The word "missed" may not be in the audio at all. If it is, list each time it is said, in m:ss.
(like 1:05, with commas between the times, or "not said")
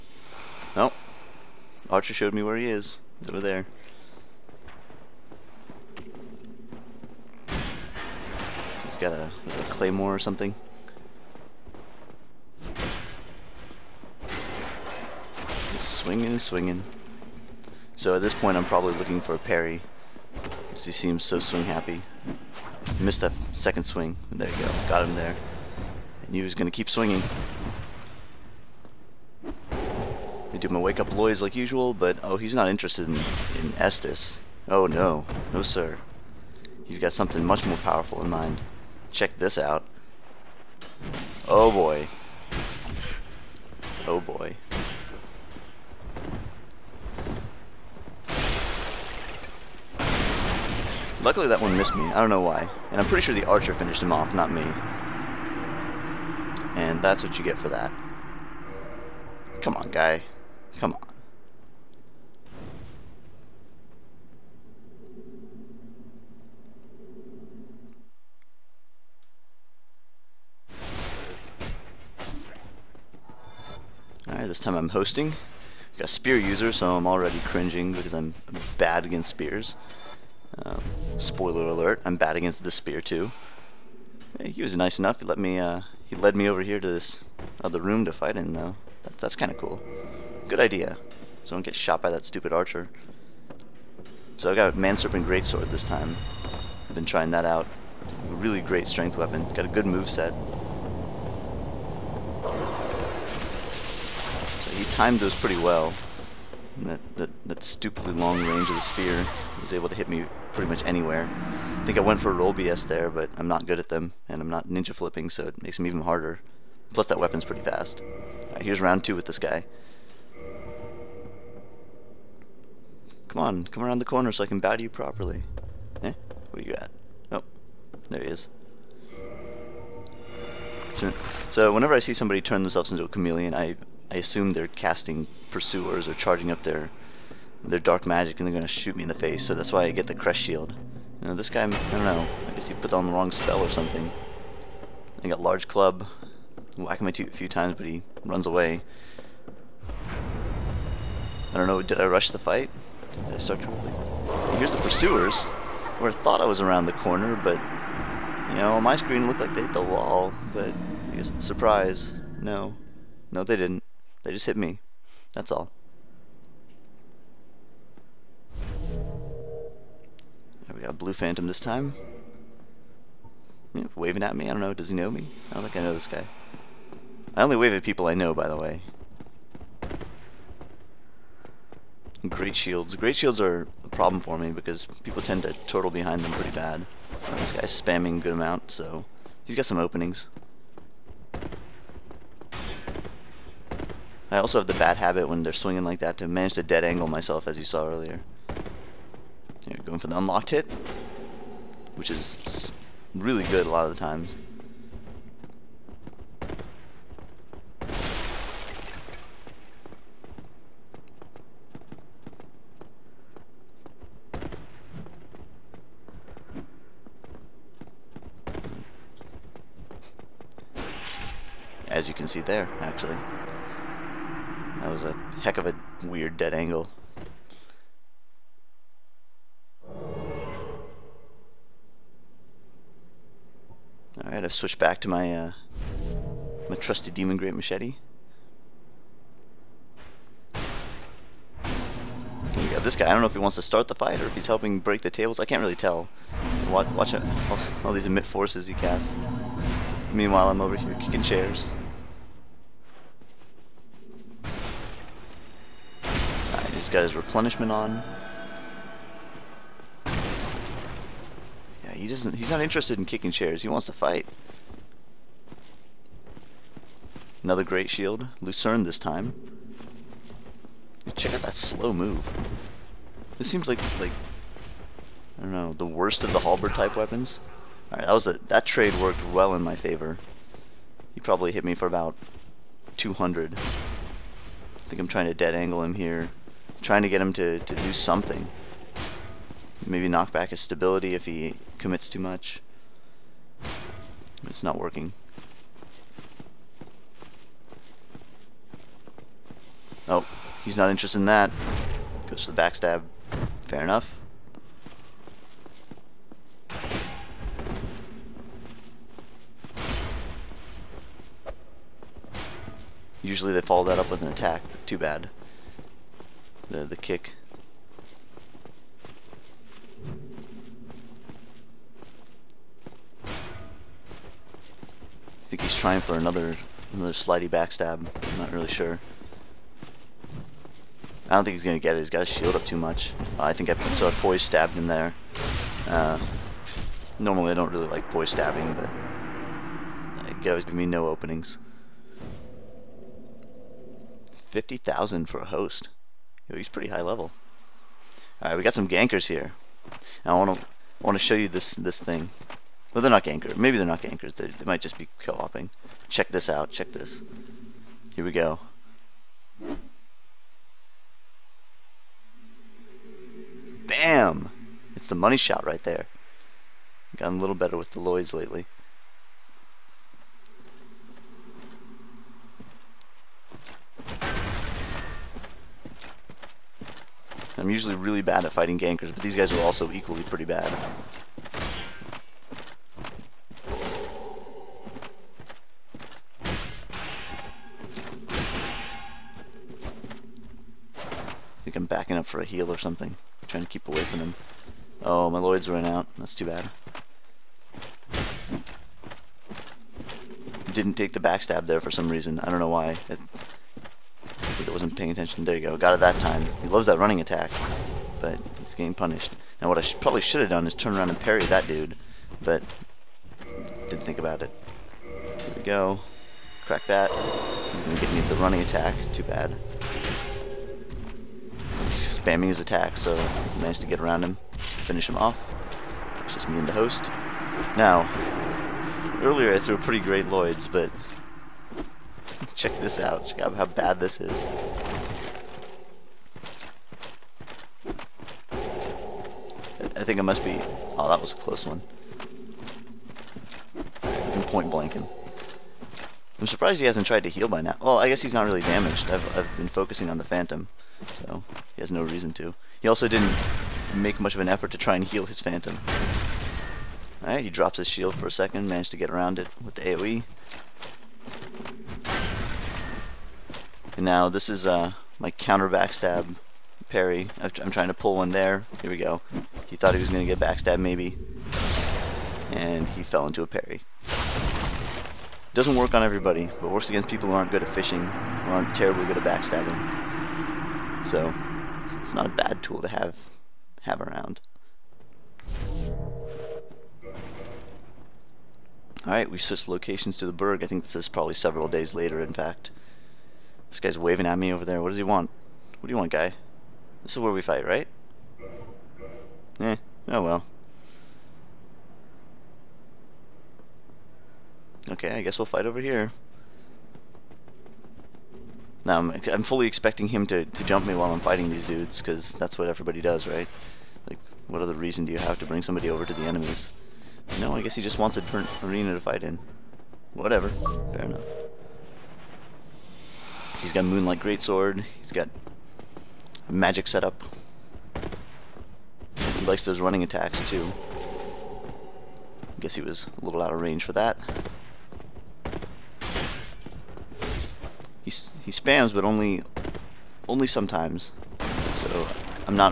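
0:22, 0:51.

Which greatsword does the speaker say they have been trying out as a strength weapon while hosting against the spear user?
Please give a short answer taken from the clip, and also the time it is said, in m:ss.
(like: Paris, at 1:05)
Manserpent Greatsword, at 1:34.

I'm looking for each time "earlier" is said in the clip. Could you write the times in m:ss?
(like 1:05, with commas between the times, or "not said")
3:17, 7:09.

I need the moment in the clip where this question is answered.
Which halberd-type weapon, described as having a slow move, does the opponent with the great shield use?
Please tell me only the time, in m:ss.
4:28.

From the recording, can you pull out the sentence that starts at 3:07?
Uh, this guy's spamming a good amount, so he's got some openings.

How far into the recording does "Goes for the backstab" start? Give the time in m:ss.
5:02.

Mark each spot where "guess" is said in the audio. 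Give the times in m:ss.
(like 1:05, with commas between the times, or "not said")
2:22, 2:41, 7:28, 8:25, 8:37, 8:52.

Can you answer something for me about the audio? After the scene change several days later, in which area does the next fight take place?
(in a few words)
the Burg.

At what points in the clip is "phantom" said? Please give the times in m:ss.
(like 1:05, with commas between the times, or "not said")
2:51, 7:30, 7:35.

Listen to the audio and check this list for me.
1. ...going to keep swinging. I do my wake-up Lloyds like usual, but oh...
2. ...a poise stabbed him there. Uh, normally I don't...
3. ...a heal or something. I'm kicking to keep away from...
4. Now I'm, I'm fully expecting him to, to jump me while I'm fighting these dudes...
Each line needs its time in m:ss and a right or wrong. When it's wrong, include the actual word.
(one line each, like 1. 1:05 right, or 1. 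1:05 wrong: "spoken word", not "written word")
1. 0:26 right
2. 5:34 right
3. 6:32 wrong: "trying", not "kicking"
4. 8:28 right.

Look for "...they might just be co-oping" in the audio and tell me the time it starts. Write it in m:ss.
5:54.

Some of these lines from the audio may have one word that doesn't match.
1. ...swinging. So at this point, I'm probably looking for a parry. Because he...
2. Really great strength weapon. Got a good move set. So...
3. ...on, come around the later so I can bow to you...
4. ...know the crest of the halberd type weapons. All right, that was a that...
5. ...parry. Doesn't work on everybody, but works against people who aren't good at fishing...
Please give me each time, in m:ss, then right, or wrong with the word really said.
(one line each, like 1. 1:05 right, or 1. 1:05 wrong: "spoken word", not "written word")
1. 0:16 right
2. 1:38 right
3. 2:03 wrong: "corner", not "later"
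4. 4:35 wrong: "worst", not "crest"
5. 7:53 right.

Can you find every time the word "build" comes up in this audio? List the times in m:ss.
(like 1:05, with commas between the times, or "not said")
not said.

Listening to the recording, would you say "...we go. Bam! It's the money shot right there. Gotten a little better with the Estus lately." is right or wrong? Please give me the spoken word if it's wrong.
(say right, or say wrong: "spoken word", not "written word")
wrong: "Lloyds", not "Estus".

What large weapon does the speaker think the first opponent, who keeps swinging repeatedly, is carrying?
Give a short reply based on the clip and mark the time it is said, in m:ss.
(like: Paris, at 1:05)
claymore, at 0:09.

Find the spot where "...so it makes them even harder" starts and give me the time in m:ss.
1:55.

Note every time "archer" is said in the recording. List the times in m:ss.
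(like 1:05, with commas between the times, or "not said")
0:01, 0:53, 1:32.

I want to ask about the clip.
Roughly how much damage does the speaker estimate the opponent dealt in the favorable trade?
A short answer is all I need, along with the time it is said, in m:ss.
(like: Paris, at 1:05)
200, at 4:41.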